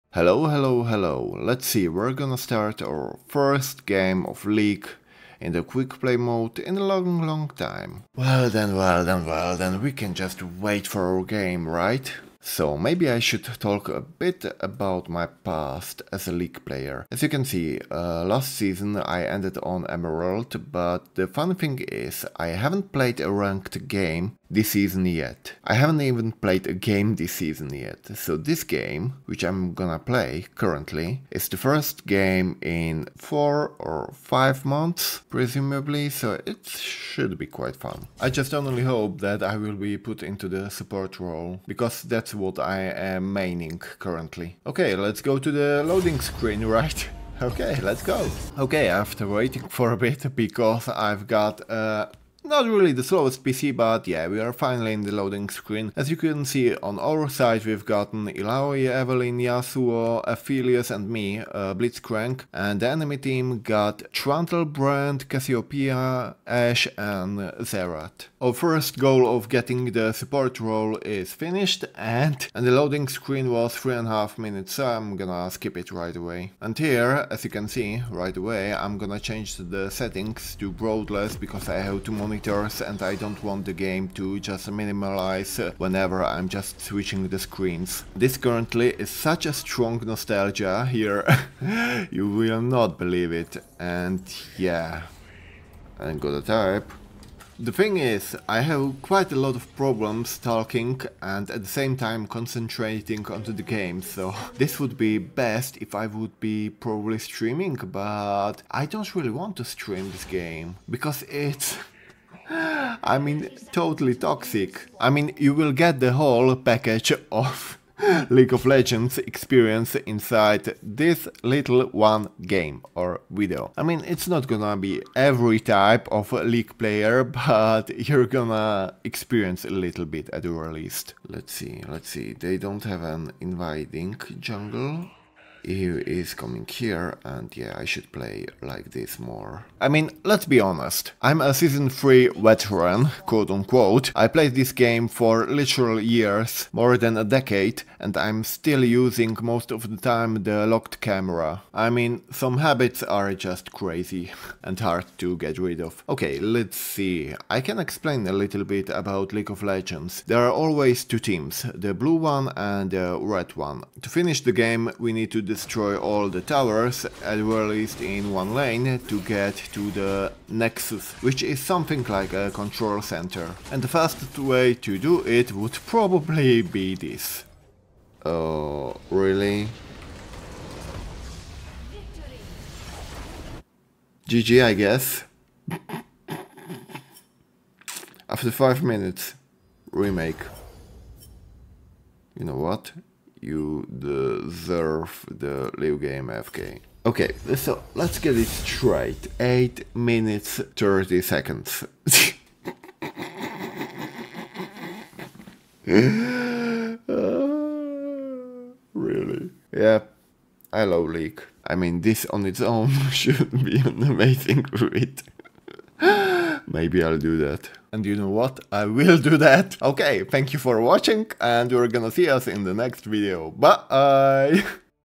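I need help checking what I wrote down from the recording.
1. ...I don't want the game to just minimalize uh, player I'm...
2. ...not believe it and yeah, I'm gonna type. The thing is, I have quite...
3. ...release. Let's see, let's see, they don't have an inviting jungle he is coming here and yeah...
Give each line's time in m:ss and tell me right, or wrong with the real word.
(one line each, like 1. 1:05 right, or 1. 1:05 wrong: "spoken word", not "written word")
1. 1:23 wrong: "whenever", not "player"
2. 1:32 right
3. 2:10 right.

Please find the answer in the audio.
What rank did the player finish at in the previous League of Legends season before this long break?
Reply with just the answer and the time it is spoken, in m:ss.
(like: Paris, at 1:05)
Emerald, at 0:19.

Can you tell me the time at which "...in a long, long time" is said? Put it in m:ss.
0:06.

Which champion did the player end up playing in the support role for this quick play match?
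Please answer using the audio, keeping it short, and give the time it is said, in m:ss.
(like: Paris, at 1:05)
Blitzcrank, at 1:01.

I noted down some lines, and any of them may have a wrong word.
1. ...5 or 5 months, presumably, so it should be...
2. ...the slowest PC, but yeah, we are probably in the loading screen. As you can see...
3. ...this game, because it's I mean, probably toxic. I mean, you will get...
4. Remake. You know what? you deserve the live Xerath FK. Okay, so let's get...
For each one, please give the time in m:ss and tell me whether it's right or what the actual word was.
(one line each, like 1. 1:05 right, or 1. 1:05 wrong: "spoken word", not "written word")
1. 0:33 wrong: "4", not "5"
2. 0:52 wrong: "finally", not "probably"
3. 1:50 wrong: "totally", not "probably"
4. 3:09 wrong: "Game", not "Xerath".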